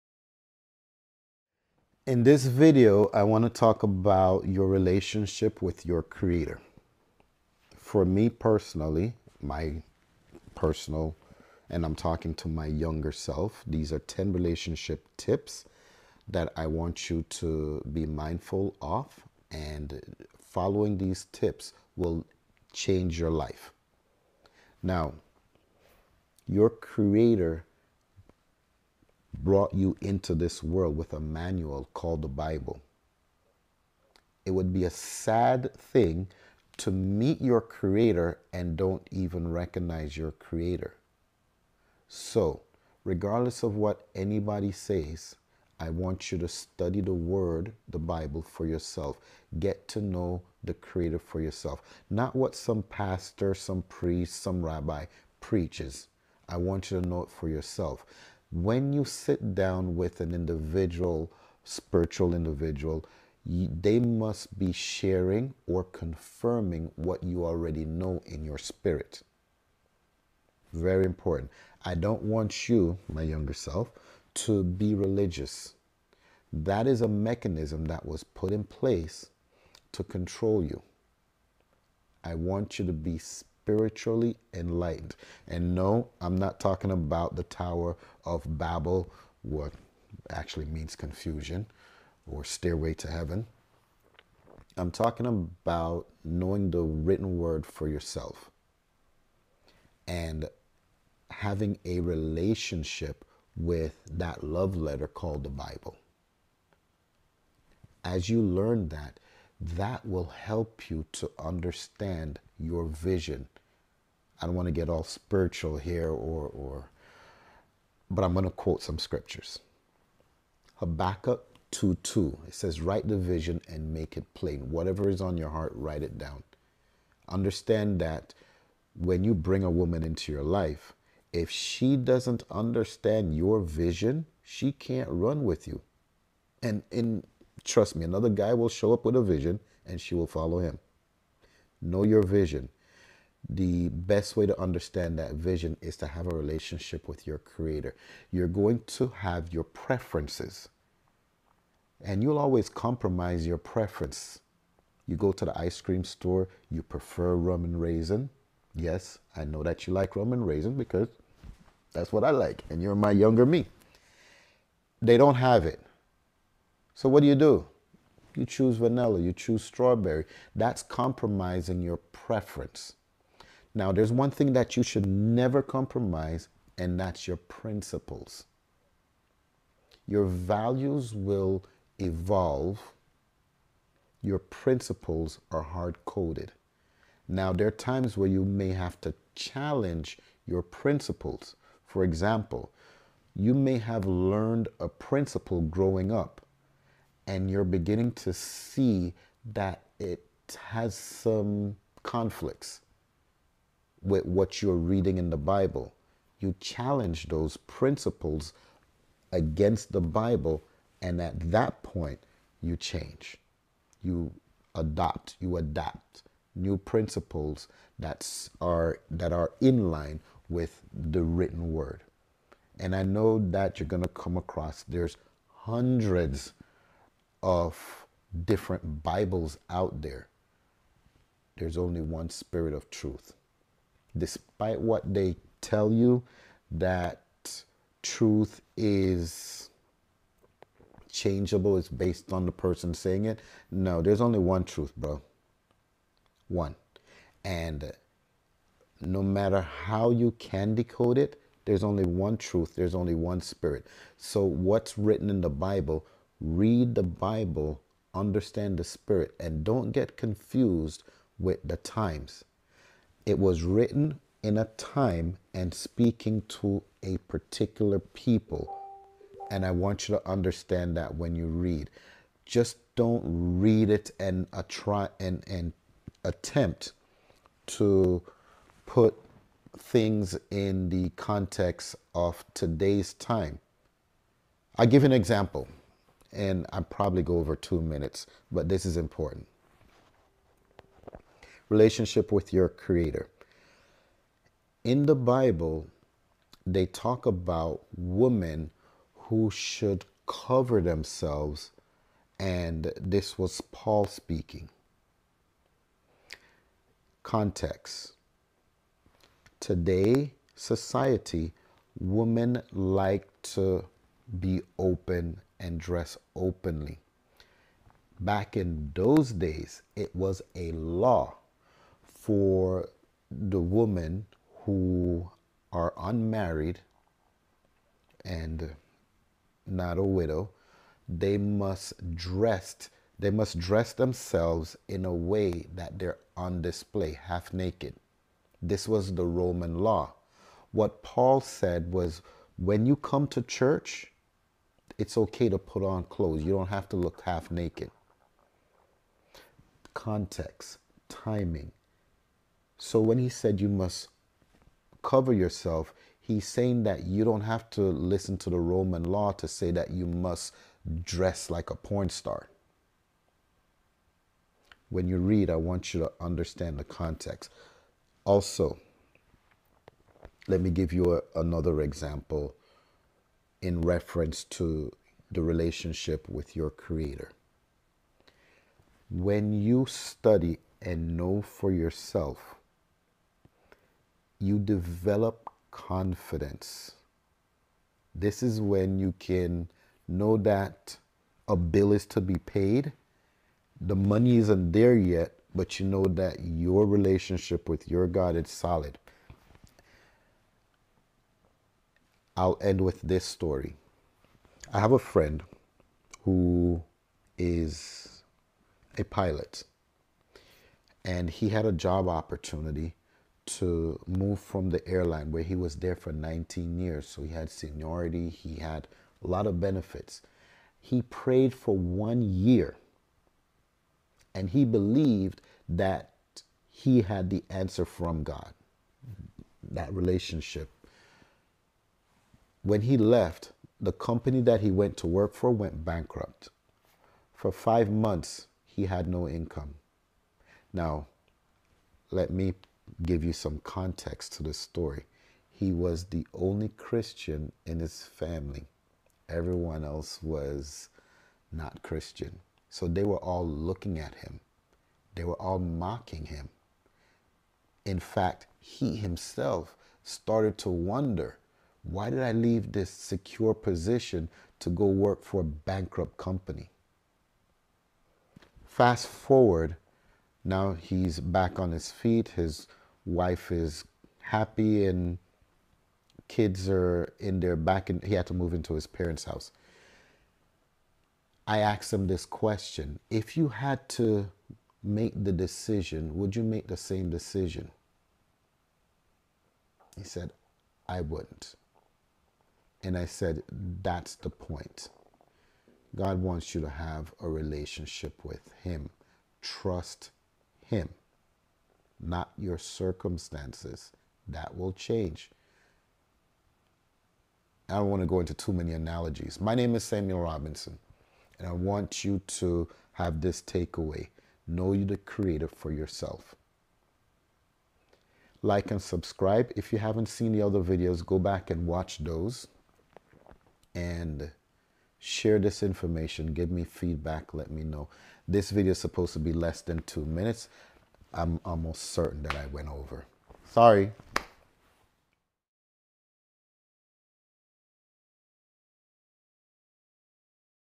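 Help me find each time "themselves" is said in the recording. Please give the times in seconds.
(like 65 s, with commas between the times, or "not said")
300 s, 333 s.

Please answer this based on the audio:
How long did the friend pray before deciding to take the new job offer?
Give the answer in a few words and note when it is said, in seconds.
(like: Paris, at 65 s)
One year, at 421 s.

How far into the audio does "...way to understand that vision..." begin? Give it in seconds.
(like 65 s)
144 s.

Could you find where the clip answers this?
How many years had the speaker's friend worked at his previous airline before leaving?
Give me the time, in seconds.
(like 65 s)
416 s.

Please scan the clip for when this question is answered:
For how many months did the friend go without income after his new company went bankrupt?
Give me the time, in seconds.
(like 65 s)
437 s.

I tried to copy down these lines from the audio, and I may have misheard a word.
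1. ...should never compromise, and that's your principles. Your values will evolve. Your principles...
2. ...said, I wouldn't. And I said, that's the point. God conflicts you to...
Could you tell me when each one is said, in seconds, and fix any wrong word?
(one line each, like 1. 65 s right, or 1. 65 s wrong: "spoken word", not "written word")
1. 174 s right
2. 490 s wrong: "wants", not "conflicts".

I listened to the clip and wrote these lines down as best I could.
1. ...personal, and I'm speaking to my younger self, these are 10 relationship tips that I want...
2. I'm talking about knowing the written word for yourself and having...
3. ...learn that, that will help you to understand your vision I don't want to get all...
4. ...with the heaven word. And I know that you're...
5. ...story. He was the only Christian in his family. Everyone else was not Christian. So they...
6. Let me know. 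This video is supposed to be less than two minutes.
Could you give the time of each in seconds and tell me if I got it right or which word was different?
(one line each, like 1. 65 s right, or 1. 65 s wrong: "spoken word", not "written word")
1. 10 s wrong: "talking", not "speaking"
2. 94 s right
3. 108 s right
4. 220 s wrong: "written", not "heaven"
5. 444 s right
6. 527 s right.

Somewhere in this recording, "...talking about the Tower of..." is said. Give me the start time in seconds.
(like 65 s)
86 s.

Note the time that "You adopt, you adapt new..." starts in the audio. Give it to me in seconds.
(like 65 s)
214 s.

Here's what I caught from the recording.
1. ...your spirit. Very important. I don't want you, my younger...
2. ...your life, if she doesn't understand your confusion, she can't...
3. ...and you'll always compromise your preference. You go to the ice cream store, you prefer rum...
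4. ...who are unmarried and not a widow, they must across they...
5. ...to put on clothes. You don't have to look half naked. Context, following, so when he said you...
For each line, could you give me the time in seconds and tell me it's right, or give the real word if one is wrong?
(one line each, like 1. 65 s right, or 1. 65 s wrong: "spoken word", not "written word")
1. 68 s right
2. 130 s wrong: "vision", not "confusion"
3. 152 s right
4. 324 s wrong: "dress", not "across"
5. 345 s wrong: "timing", not "following".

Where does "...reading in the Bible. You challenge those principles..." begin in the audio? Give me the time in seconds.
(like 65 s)
204 s.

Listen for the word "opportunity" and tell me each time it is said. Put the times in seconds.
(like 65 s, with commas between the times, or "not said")
412 s.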